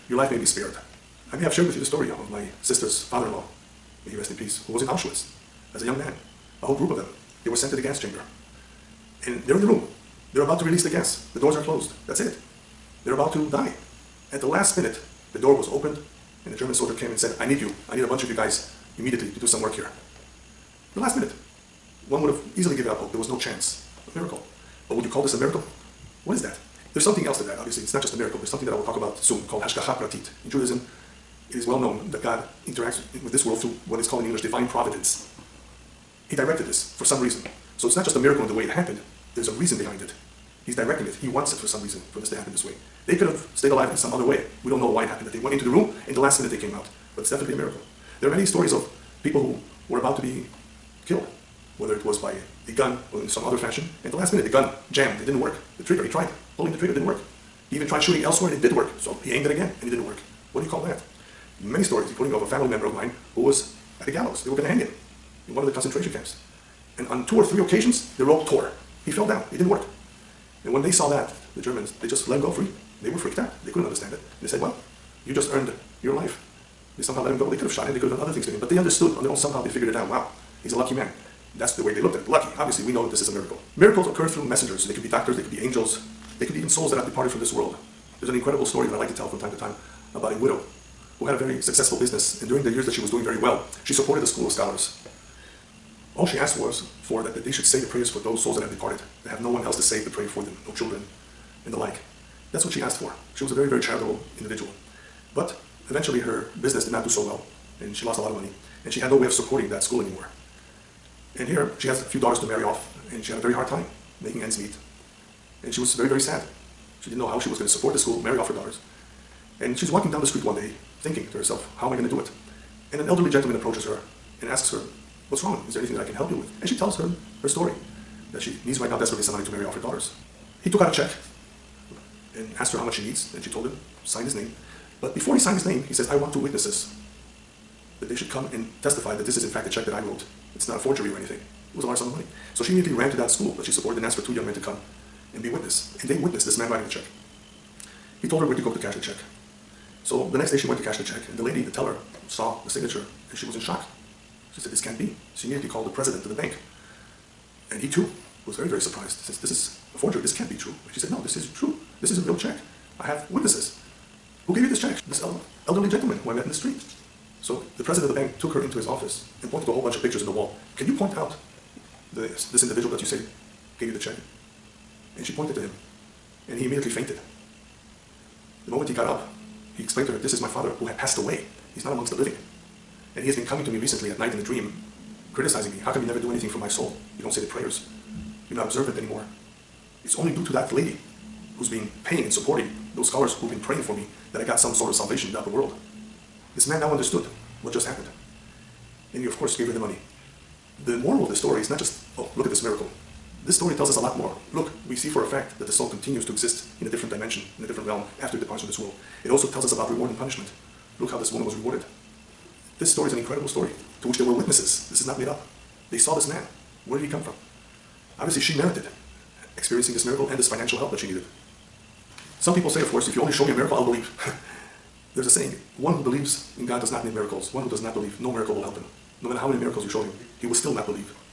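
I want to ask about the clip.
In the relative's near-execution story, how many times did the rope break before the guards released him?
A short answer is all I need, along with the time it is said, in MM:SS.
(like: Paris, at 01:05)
3, at 01:07.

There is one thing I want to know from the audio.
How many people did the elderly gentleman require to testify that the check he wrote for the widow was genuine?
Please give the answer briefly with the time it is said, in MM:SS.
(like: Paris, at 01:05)
2, at 02:16.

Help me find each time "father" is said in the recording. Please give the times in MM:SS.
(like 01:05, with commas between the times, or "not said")
00:03, 03:00.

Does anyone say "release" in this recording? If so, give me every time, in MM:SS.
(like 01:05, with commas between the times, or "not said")
00:10.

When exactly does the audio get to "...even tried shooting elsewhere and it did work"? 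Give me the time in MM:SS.
00:57.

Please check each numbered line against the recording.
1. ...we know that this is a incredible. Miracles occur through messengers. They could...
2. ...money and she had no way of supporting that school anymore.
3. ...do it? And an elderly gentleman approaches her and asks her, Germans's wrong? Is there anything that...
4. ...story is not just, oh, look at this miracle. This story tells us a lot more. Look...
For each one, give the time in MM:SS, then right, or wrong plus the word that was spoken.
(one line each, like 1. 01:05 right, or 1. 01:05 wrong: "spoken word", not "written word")
1. 01:22 wrong: "miracle", not "incredible"
2. 01:48 right
3. 02:02 wrong: "What", not "Germans"
4. 03:21 right.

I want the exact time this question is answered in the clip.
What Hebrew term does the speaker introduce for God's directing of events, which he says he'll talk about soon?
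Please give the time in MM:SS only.
00:29.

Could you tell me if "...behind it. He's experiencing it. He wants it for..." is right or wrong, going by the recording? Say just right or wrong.
wrong.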